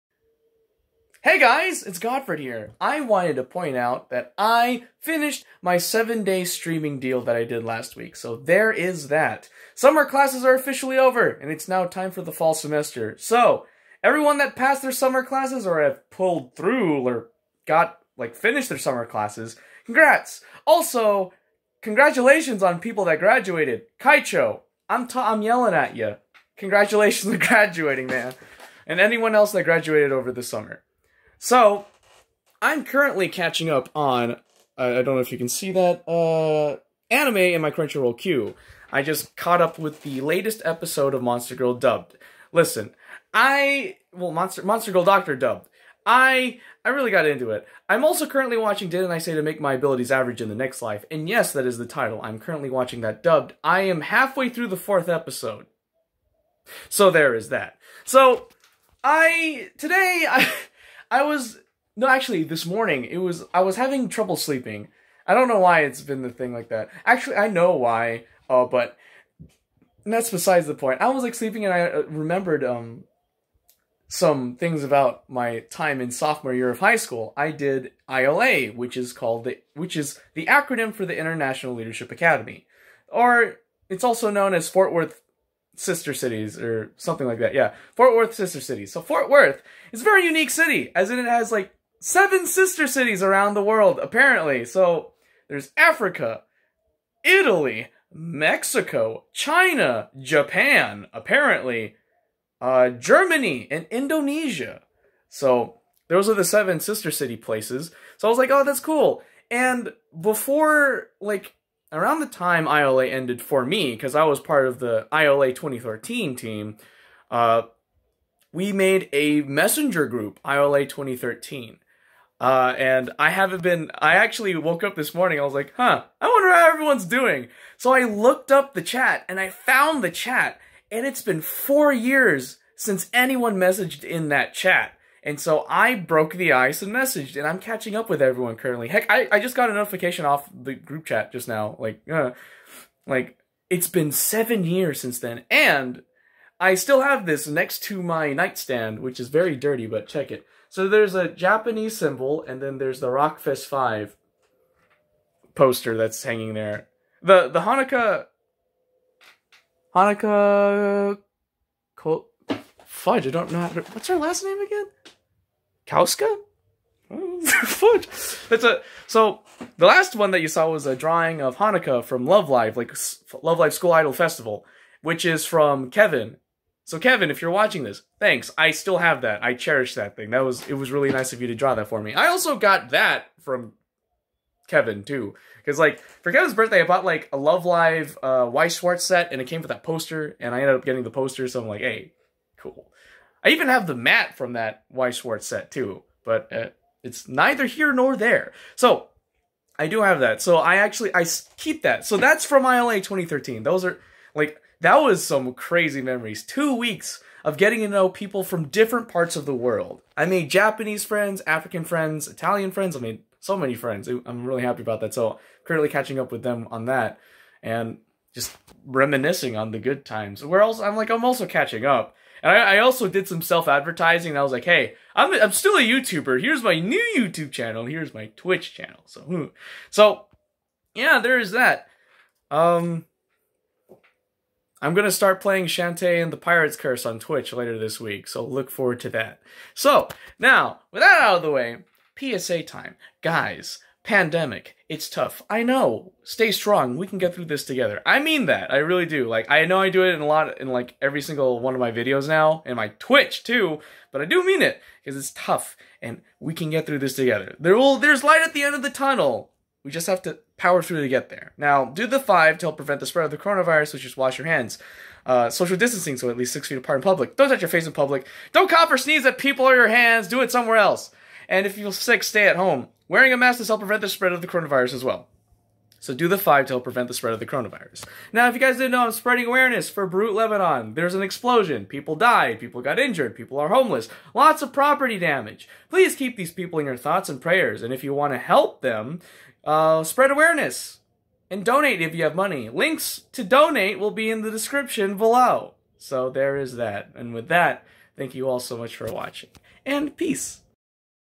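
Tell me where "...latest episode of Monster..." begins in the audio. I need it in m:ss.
0:40.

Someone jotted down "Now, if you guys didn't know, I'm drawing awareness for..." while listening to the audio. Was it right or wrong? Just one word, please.
wrong.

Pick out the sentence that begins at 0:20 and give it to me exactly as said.
Also, congratulations on people that graduated.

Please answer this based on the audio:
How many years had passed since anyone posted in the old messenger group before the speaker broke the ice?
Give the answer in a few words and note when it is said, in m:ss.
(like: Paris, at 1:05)
4, at 2:11.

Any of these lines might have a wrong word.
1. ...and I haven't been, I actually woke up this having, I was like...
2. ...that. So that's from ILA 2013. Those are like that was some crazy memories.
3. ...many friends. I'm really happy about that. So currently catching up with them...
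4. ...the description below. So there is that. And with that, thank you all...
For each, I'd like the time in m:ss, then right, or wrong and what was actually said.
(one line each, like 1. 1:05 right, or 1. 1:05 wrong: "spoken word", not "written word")
1. 2:02 wrong: "morning", not "having"
2. 3:21 right
3. 3:33 right
4. 4:54 right.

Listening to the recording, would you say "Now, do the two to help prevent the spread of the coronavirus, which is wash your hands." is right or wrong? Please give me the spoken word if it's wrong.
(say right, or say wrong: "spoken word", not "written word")
wrong: "five", not "two".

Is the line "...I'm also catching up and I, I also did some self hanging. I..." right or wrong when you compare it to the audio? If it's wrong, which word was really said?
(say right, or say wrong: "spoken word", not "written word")
wrong: "advertising", not "hanging".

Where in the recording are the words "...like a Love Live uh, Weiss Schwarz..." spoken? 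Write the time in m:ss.
3:07.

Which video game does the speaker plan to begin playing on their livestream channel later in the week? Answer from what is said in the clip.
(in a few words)
Shantae and the Pirate's Curse.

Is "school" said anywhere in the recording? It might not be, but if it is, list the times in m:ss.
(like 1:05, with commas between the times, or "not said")
1:16, 2:53.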